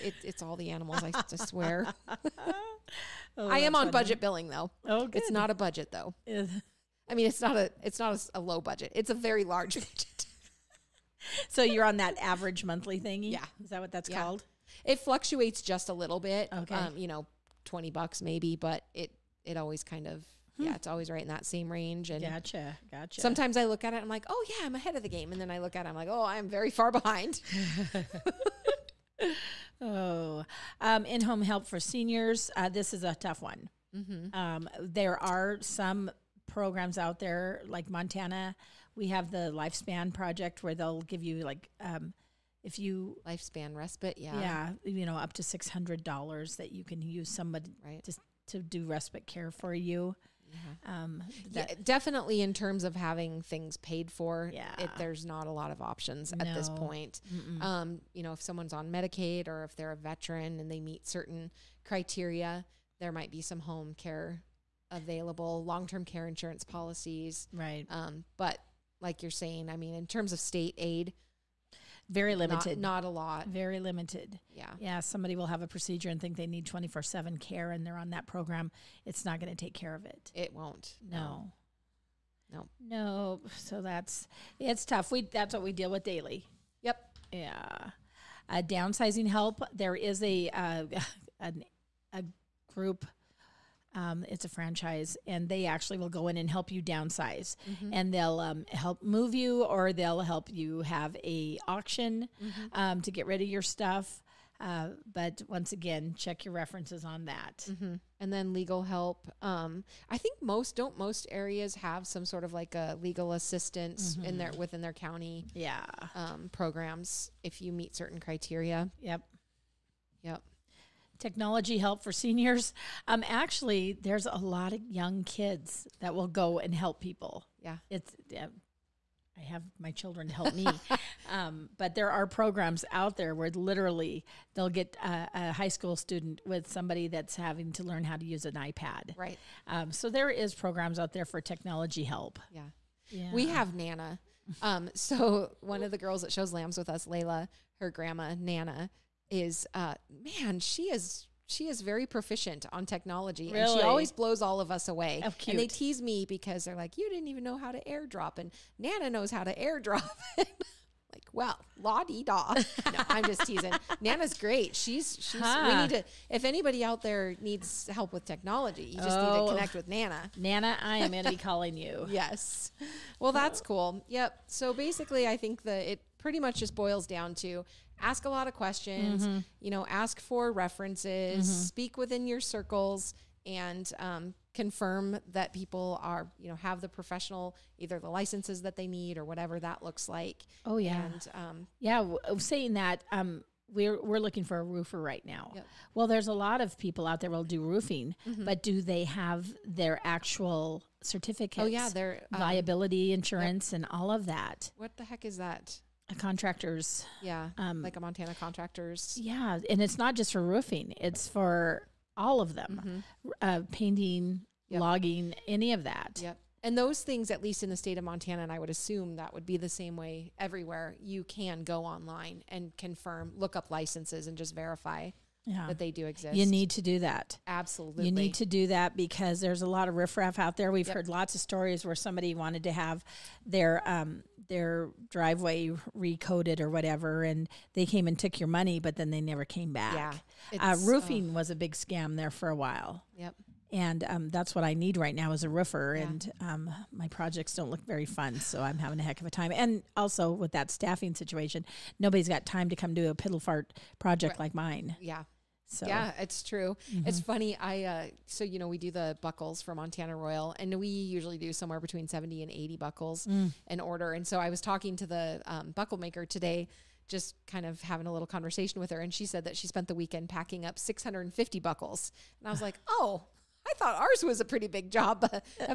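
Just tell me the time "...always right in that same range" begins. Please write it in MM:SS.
00:20.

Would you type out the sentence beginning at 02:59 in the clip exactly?
you know, ask for references, mm-hmm.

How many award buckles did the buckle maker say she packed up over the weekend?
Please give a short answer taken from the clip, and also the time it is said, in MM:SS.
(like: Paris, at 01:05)
650, at 04:30.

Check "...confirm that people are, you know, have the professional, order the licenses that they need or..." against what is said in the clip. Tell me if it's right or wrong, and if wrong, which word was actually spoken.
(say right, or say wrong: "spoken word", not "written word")
wrong: "either", not "order".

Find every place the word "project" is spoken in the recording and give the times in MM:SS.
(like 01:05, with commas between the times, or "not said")
00:40, 04:07, 04:13.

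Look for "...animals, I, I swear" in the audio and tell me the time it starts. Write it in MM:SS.
00:00.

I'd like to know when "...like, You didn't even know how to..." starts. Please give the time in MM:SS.
02:36.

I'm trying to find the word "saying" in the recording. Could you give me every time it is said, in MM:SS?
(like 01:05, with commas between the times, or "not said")
01:09, 03:12.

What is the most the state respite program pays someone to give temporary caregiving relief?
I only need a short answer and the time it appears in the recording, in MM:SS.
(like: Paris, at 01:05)
$600, at 00:45.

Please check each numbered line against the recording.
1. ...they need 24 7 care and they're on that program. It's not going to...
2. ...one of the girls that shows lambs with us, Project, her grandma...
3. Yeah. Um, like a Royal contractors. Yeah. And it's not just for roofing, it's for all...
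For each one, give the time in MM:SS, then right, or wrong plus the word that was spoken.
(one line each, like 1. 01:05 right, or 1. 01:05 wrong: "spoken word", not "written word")
1. 01:16 right
2. 02:25 wrong: "Layla", not "Project"
3. 03:27 wrong: "Montana", not "Royal".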